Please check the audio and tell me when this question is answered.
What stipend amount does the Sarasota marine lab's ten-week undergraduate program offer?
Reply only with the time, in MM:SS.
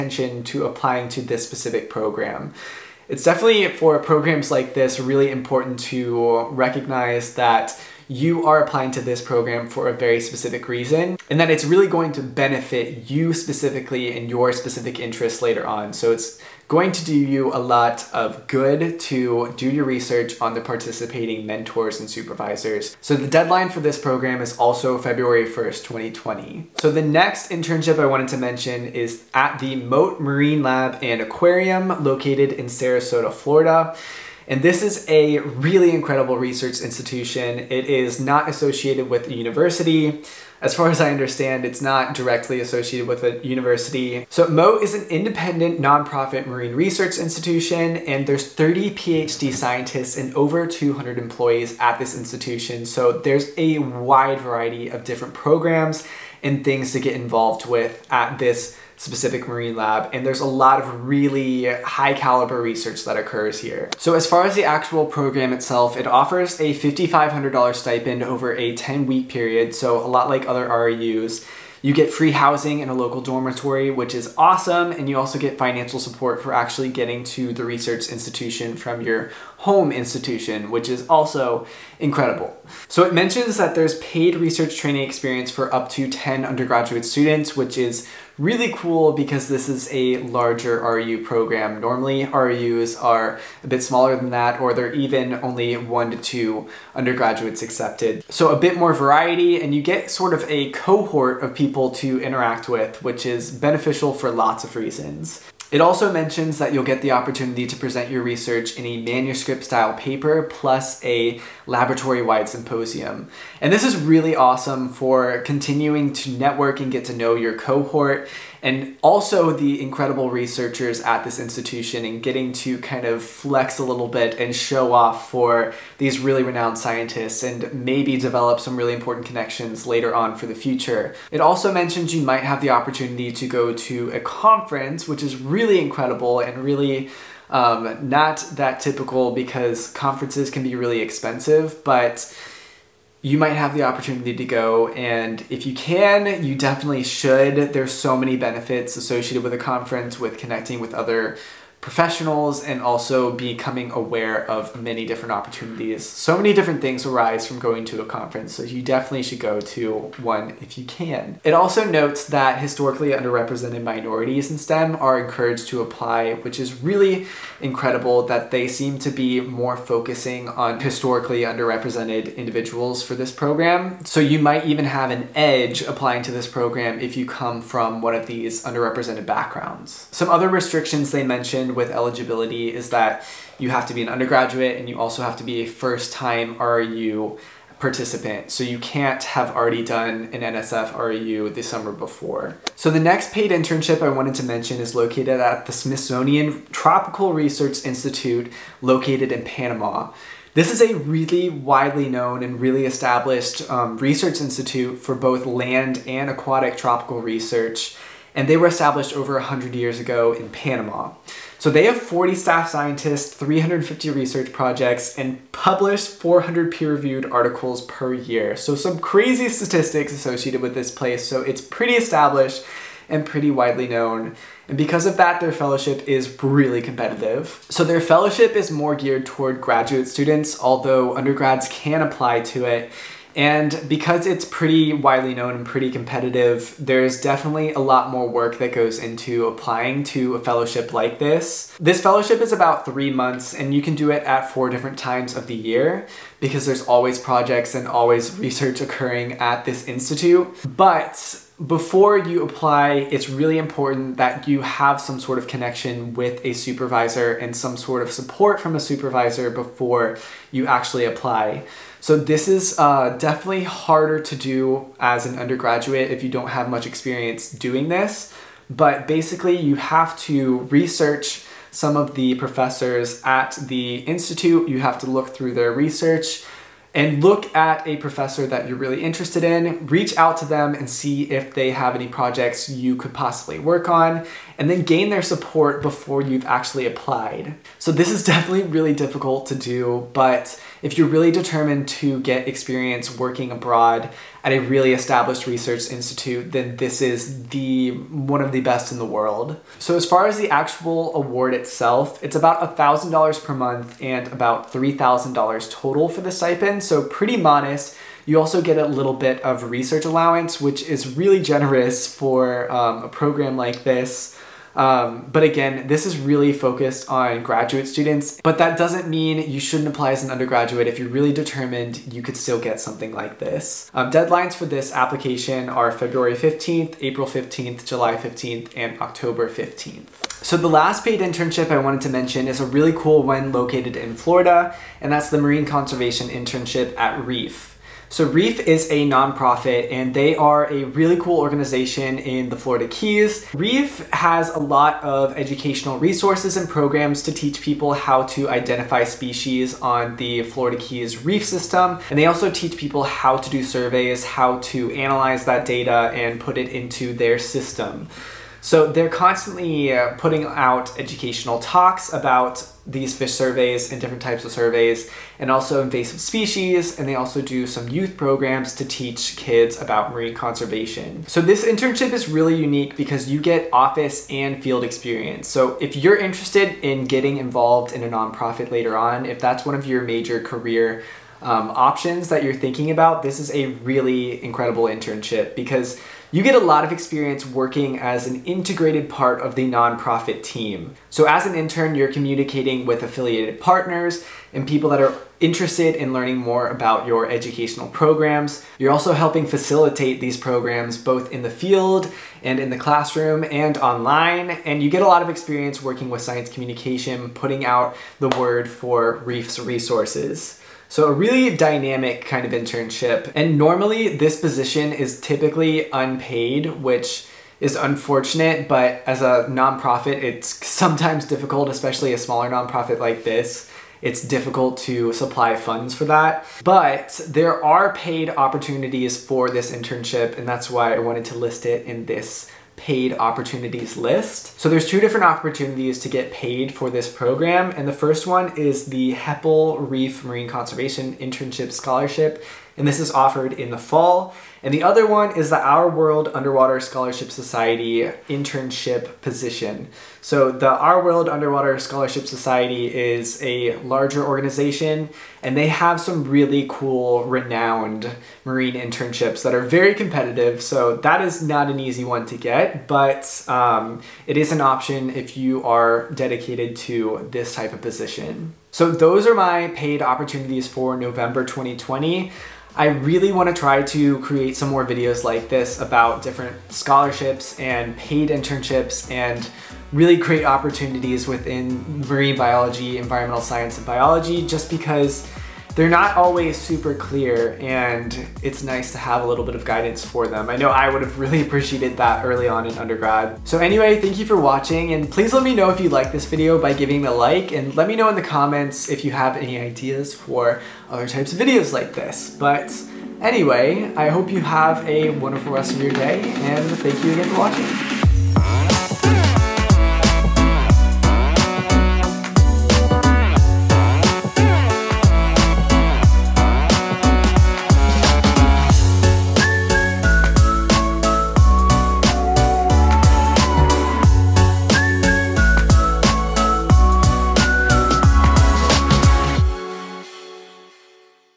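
01:06.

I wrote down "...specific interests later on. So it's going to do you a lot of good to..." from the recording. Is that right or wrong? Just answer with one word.
right.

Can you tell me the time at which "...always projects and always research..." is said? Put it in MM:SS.
04:06.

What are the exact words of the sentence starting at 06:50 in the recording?
So a really dynamic kind of internship.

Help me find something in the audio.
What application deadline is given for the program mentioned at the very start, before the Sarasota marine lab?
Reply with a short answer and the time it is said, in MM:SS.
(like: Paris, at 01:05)
February 1st, 2020, at 00:24.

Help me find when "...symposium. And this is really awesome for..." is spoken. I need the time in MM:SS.
01:52.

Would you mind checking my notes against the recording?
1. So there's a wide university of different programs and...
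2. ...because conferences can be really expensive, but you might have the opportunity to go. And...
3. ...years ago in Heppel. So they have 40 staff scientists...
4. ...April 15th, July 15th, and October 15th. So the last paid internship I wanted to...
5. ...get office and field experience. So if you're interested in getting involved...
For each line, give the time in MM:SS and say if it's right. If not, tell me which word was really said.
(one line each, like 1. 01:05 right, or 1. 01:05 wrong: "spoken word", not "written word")
1. 00:52 wrong: "variety", not "university"
2. 02:19 right
3. 03:29 wrong: "Panama", not "Heppel"
4. 05:26 right
5. 06:13 right.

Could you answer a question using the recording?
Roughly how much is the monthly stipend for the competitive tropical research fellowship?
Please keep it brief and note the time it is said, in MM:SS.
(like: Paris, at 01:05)
$1,000, at 05:02.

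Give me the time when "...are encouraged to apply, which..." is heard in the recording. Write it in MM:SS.
02:44.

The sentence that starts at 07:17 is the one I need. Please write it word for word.
And the first one is the Heppel Reef Marine Conservation Internship Scholarship and this is offered in the fall.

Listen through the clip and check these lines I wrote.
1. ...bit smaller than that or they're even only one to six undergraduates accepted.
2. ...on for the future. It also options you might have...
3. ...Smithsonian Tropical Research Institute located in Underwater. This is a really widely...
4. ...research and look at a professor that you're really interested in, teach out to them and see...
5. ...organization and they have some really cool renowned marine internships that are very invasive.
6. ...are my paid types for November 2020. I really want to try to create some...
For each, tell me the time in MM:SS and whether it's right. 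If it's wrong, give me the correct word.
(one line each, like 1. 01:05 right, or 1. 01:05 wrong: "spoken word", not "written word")
1. 01:33 wrong: "two", not "six"
2. 02:10 wrong: "mentions", not "options"
3. 03:15 wrong: "Panama", not "Underwater"
4. 04:35 wrong: "reach", not "teach"
5. 07:34 wrong: "competitive", not "invasive"
6. 07:49 wrong: "opportunities", not "types".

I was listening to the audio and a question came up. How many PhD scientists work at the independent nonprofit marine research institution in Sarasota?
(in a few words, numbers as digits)
30.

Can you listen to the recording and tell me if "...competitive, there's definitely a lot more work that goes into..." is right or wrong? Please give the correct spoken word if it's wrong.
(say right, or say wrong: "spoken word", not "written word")
right.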